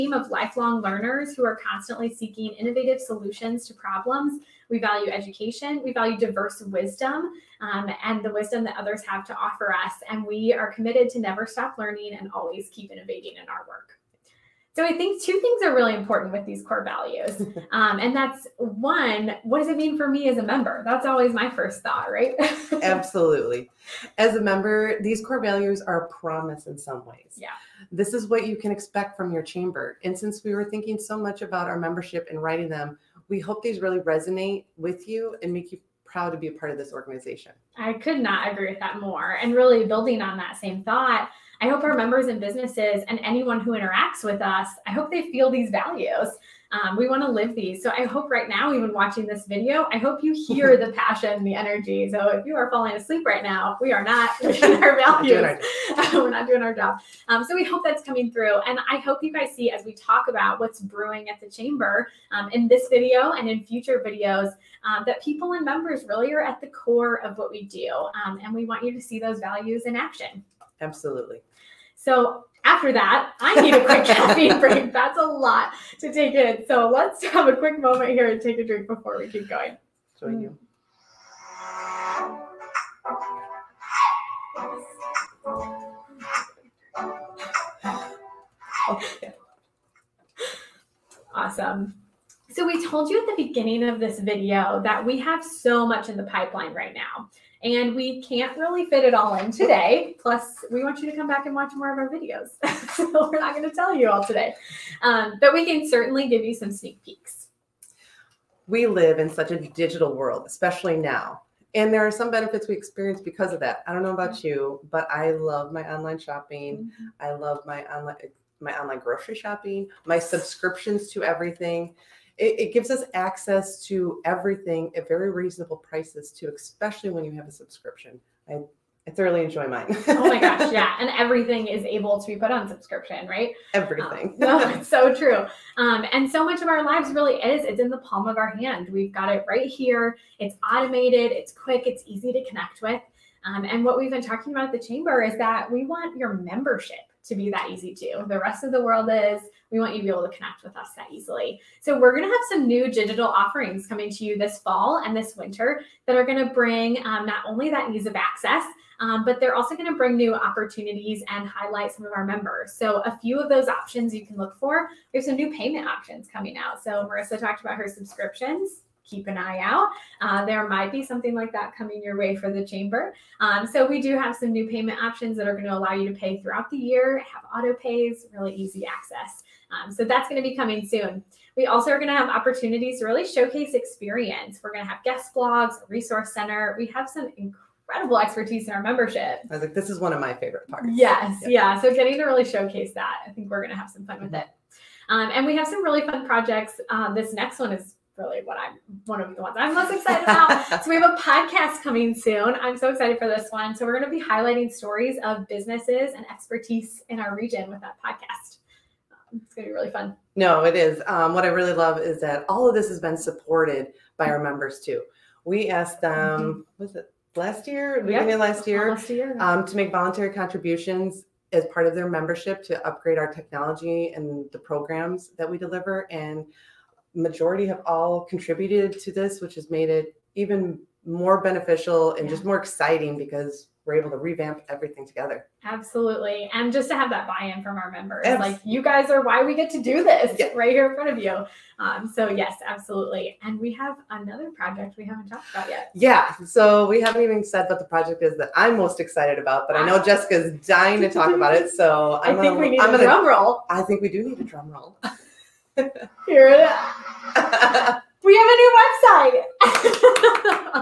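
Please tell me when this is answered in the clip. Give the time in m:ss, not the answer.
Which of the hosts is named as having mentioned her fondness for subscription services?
2:47.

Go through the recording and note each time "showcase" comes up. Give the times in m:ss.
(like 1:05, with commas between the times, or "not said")
3:03, 3:12.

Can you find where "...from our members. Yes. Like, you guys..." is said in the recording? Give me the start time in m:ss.
3:57.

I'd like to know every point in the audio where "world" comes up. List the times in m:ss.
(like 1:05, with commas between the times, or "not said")
1:50, 2:28.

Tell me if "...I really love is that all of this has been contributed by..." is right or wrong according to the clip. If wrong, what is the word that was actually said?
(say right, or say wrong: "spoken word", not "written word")
wrong: "supported", not "contributed".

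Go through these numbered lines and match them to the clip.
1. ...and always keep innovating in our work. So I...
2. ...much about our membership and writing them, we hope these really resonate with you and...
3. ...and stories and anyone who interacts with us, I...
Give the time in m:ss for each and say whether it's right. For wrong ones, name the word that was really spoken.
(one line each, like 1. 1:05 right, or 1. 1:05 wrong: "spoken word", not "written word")
1. 0:12 right
2. 0:31 right
3. 0:42 wrong: "businesses", not "stories".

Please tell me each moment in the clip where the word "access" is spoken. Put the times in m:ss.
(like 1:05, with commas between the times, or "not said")
2:03, 2:38, 2:58.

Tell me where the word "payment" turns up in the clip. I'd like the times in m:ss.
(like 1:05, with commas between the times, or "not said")
2:45, 2:54.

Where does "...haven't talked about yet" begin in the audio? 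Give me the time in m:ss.
4:05.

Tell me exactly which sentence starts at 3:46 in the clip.
And majority have all contributed to this, which has made it even more beneficial and yeah.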